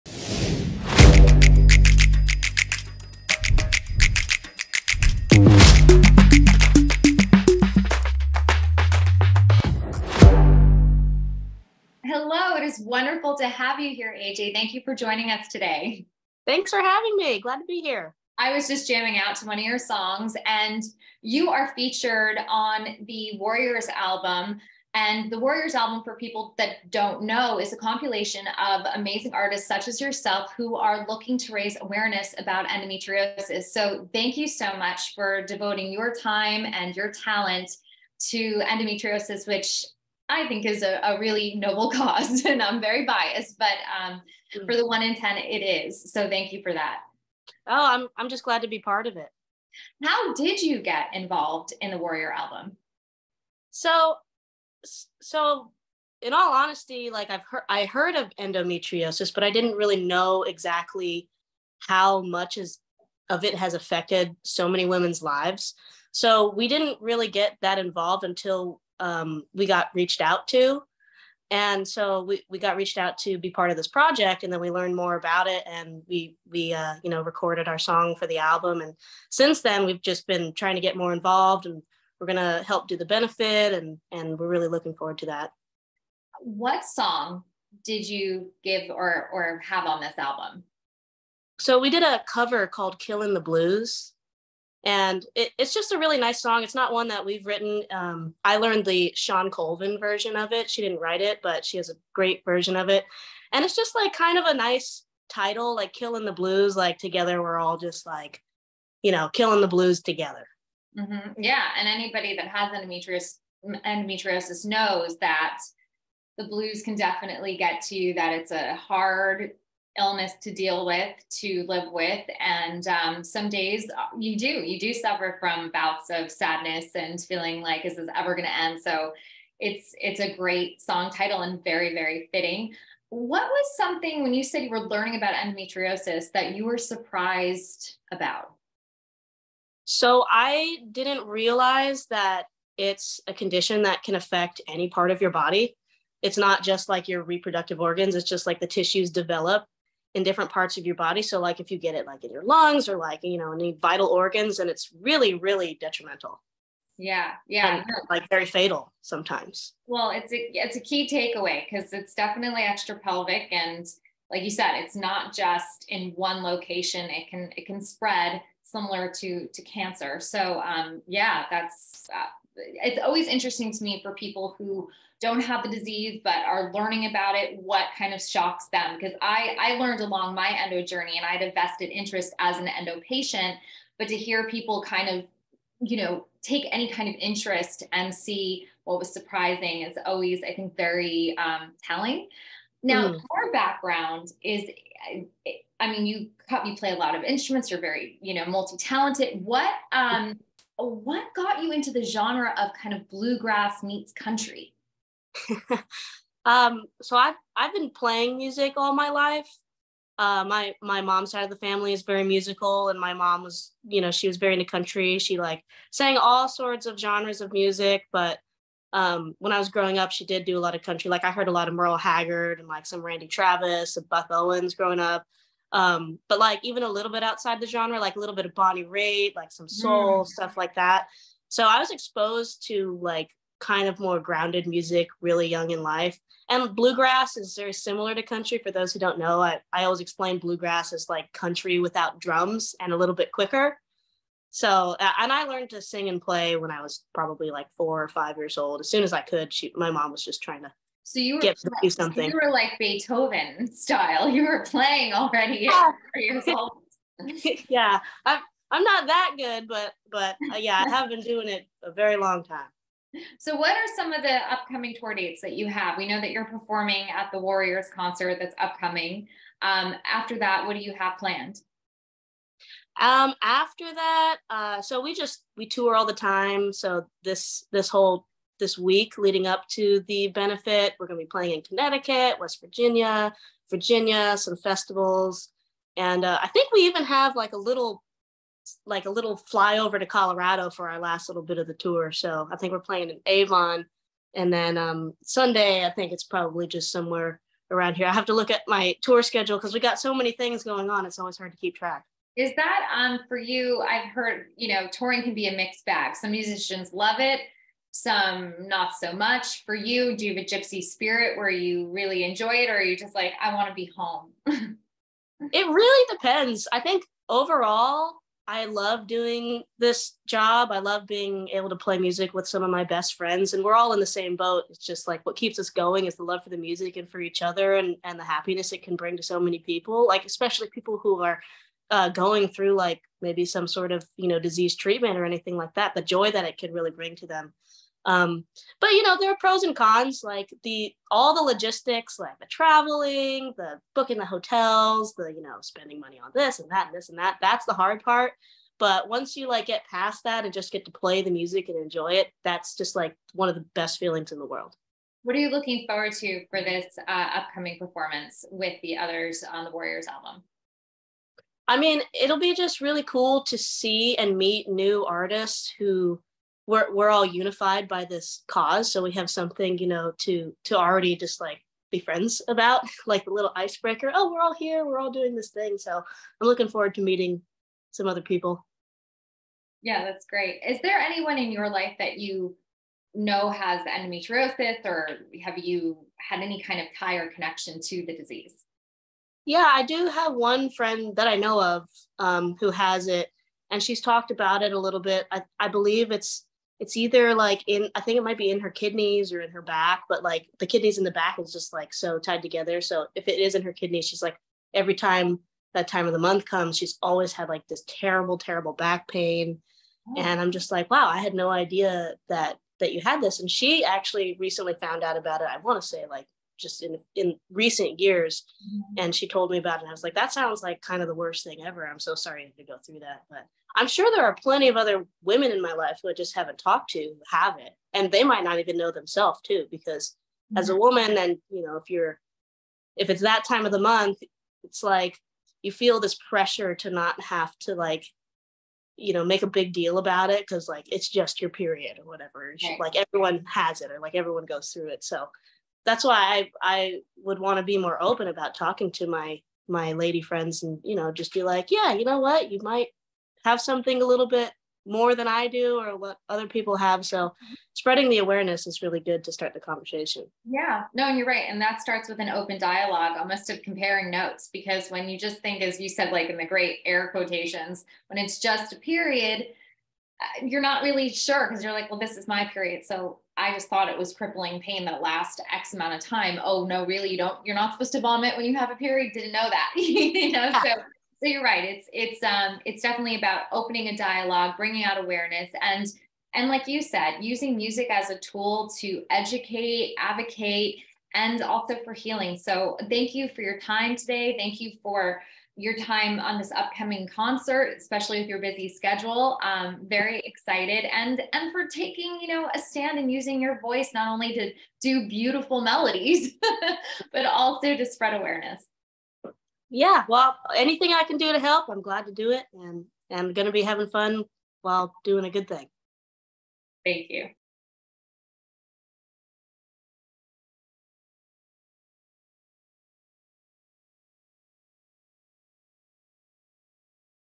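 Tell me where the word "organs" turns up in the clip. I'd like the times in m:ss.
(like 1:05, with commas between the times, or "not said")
2:27, 2:34.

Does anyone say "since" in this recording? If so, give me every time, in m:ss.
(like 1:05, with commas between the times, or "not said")
1:19.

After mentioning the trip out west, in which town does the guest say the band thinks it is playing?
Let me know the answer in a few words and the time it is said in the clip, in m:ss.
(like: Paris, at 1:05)
Avon, at 4:53.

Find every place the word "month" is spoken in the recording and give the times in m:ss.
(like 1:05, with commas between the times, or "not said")
6:46, 7:13.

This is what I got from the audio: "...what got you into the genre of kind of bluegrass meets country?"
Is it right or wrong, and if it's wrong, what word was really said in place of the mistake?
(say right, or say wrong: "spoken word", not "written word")
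right.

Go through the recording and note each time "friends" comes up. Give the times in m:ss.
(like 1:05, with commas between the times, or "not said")
5:23, 6:12, 6:30, 7:30.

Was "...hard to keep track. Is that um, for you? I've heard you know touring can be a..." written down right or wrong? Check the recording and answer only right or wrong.
right.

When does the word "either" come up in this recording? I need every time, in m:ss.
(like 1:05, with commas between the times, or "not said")
6:36.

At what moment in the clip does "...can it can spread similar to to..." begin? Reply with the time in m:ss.
2:47.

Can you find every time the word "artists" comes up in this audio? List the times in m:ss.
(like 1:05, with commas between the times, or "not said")
0:29, 6:05.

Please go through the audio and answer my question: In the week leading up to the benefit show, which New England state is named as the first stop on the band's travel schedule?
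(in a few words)
Connecticut.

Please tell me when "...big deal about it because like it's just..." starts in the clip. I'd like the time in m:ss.
7:19.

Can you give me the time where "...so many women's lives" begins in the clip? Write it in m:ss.
1:04.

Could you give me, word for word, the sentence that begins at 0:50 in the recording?
How did you get involved in the Warrior album?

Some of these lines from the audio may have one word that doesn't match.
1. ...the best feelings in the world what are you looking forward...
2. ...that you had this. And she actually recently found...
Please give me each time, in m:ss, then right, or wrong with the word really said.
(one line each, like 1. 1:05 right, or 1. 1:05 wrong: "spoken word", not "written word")
1. 5:53 right
2. 6:52 right.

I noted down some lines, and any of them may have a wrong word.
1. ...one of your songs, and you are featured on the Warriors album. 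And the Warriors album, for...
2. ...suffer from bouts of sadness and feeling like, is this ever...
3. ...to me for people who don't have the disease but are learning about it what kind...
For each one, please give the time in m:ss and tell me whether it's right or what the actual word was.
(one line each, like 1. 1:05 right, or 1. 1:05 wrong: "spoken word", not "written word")
1. 0:19 right
2. 2:04 right
3. 2:53 right.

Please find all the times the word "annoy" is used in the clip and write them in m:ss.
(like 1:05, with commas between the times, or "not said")
not said.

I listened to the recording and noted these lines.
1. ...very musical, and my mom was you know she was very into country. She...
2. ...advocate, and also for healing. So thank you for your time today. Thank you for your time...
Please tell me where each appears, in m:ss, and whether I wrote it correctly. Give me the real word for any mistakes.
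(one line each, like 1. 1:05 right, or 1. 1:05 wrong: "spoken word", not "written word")
1. 3:32 right
2. 8:09 right.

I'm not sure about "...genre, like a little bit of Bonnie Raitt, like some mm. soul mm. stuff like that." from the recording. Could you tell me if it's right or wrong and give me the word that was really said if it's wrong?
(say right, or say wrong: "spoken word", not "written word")
right.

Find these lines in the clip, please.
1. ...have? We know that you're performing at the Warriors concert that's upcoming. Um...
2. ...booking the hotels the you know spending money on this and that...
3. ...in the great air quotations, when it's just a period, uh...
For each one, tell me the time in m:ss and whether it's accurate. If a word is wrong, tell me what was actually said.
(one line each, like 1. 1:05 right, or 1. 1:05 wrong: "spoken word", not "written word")
1. 4:25 right
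2. 5:43 right
3. 7:46 right.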